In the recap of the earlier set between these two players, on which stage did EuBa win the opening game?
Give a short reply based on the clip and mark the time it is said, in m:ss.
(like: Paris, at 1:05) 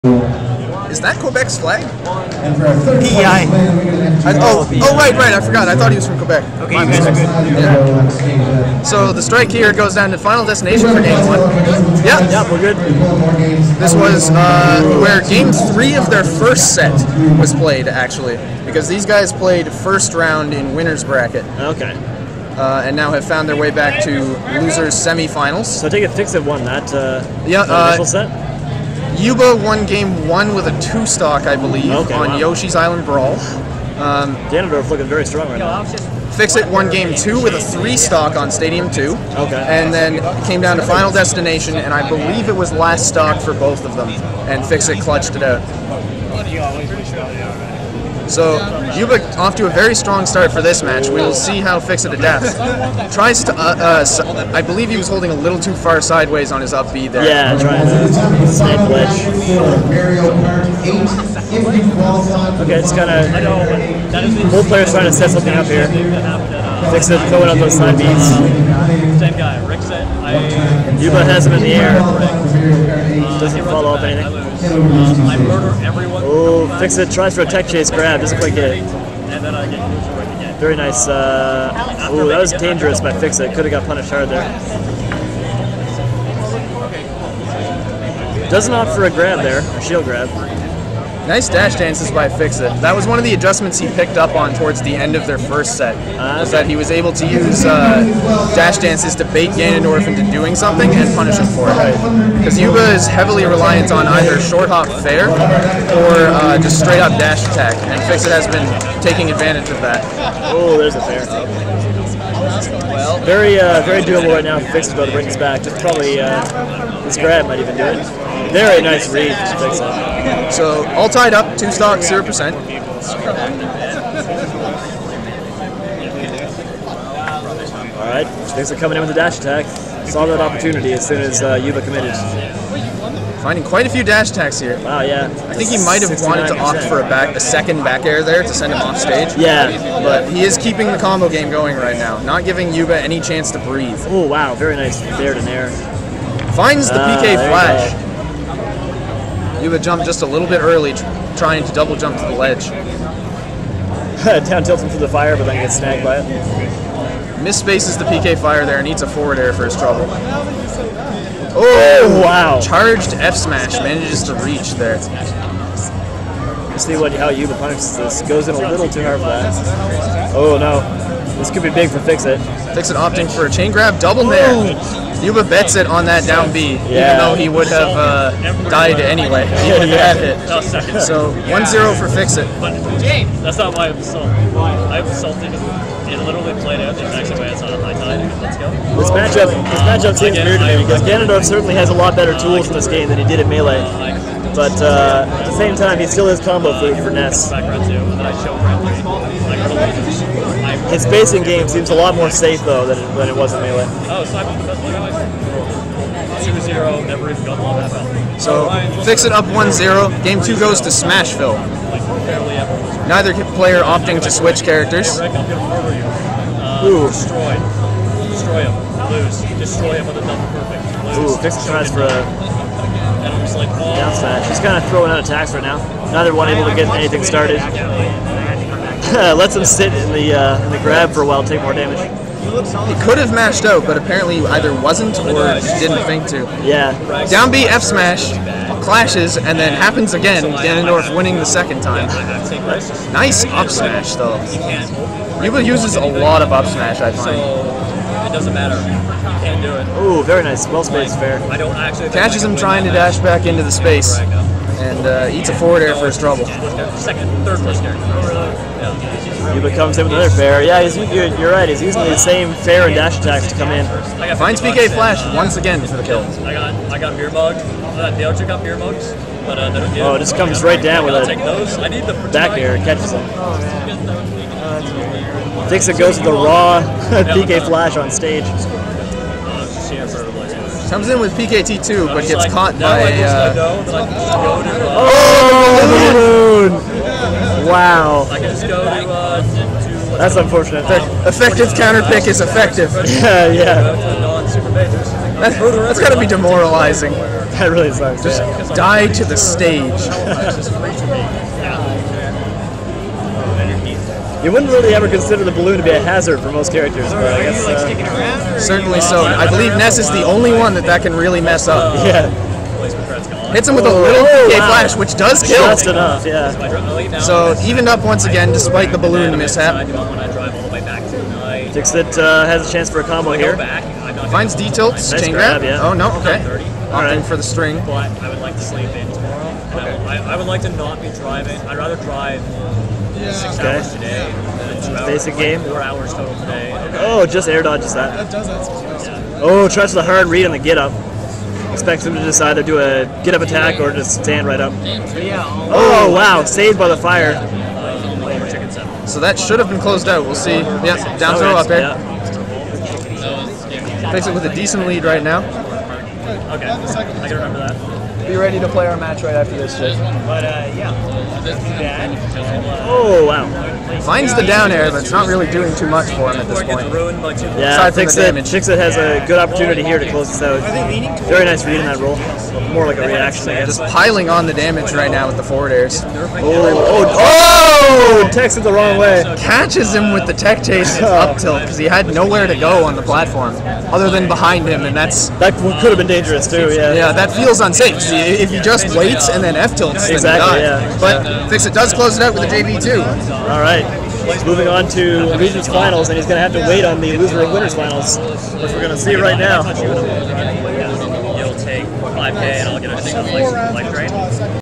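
Yoshi's Island Brawl, at 0:32.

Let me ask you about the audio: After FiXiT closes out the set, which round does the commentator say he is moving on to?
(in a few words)
Regions Finals.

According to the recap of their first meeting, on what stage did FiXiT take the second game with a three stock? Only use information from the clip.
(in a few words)
Stadium 2.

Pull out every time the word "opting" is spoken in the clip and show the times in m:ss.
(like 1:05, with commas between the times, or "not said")
2:52, 3:33, 5:26.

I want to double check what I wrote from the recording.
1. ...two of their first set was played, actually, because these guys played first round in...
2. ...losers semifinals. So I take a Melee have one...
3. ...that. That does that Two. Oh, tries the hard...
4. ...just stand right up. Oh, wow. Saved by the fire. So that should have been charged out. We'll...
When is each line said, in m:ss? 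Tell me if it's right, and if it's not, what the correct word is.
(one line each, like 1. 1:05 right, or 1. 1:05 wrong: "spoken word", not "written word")
1. 0:15 wrong: "three", not "two"
2. 0:24 wrong: "Fix", not "Melee"
3. 5:37 wrong: "Yeah", not "Two"
4. 5:43 wrong: "closed", not "charged".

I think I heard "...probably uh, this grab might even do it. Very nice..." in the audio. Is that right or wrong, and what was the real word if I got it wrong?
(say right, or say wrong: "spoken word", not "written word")
right.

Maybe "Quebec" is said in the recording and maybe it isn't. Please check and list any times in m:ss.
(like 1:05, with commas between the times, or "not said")
0:01, 0:06.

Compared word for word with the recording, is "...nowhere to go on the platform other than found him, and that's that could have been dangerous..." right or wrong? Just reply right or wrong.
wrong.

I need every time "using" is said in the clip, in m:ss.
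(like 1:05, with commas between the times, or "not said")
4:21.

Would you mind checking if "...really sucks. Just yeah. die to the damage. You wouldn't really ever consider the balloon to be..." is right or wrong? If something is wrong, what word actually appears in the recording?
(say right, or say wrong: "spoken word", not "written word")
wrong: "stage", not "damage".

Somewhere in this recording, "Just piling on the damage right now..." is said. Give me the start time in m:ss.
6:13.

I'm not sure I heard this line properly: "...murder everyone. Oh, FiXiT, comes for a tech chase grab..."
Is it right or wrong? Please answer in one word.
wrong.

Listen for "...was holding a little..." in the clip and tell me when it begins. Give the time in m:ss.
0:54.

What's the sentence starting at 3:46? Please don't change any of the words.
Neither one able to get anything started.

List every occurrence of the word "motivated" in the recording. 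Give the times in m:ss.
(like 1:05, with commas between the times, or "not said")
not said.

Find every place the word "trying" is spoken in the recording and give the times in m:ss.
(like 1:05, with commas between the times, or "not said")
0:57, 1:04, 2:31, 4:12.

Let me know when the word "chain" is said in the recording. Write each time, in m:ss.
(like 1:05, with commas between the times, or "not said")
2:53, 5:25.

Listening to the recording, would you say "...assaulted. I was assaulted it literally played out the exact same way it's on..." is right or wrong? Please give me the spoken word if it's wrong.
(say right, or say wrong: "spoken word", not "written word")
right.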